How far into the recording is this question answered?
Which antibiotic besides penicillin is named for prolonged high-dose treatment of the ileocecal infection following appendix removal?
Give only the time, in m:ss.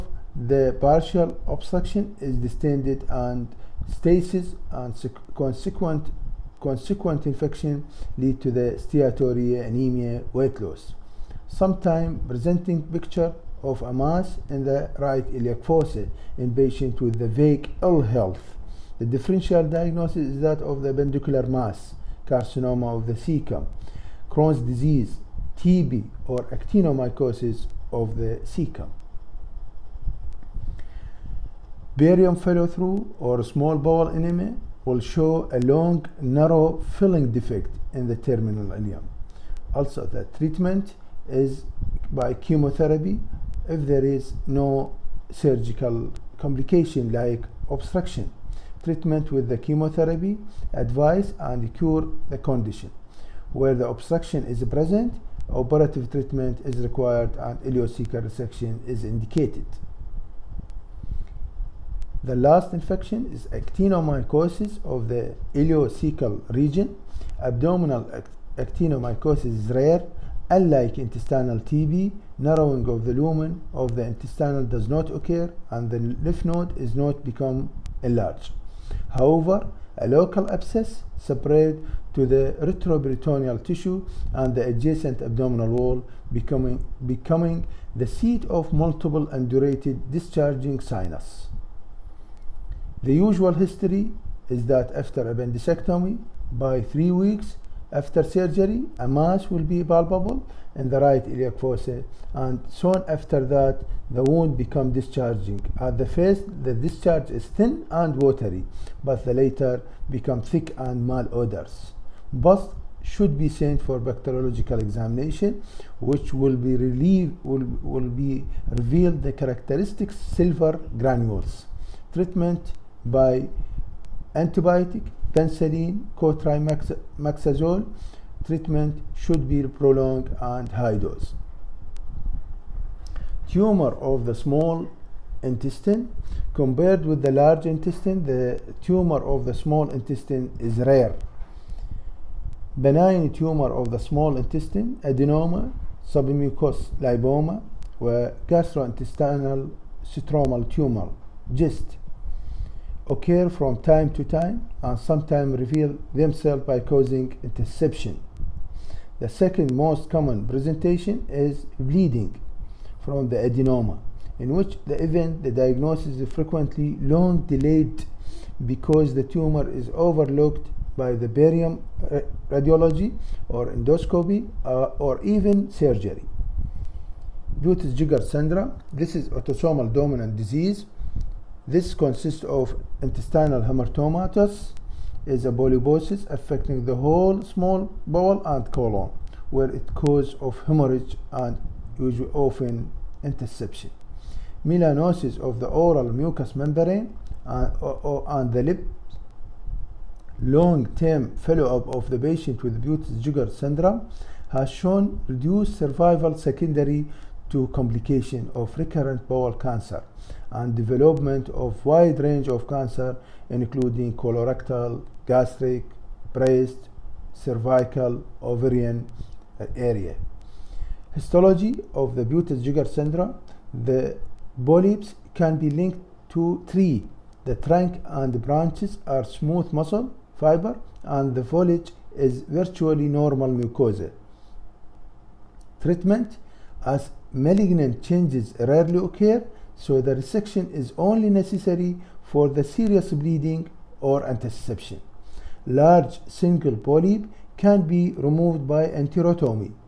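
2:06.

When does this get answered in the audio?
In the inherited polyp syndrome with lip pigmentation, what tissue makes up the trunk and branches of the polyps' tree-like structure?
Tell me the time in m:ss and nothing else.
3:49.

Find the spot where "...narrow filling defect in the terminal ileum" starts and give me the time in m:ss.
0:36.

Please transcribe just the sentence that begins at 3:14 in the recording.
Melanosis of the oral mucous membrane and, or, or, and the lip.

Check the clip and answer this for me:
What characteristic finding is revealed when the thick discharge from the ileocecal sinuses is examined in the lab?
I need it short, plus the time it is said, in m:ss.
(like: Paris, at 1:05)
sulfur granules, at 2:00.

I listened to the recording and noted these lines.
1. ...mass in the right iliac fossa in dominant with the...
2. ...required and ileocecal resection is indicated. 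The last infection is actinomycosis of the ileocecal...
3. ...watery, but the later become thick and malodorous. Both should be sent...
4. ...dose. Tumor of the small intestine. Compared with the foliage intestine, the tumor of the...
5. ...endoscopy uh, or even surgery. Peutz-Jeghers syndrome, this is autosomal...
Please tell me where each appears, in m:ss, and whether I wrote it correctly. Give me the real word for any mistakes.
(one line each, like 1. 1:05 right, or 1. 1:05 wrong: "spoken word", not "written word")
1. 0:13 wrong: "patient", not "dominant"
2. 0:56 right
3. 1:48 right
4. 2:10 wrong: "large", not "foliage"
5. 2:53 right.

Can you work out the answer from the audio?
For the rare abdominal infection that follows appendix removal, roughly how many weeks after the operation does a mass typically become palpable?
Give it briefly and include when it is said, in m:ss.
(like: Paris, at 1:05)
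3 weeks, at 1:36.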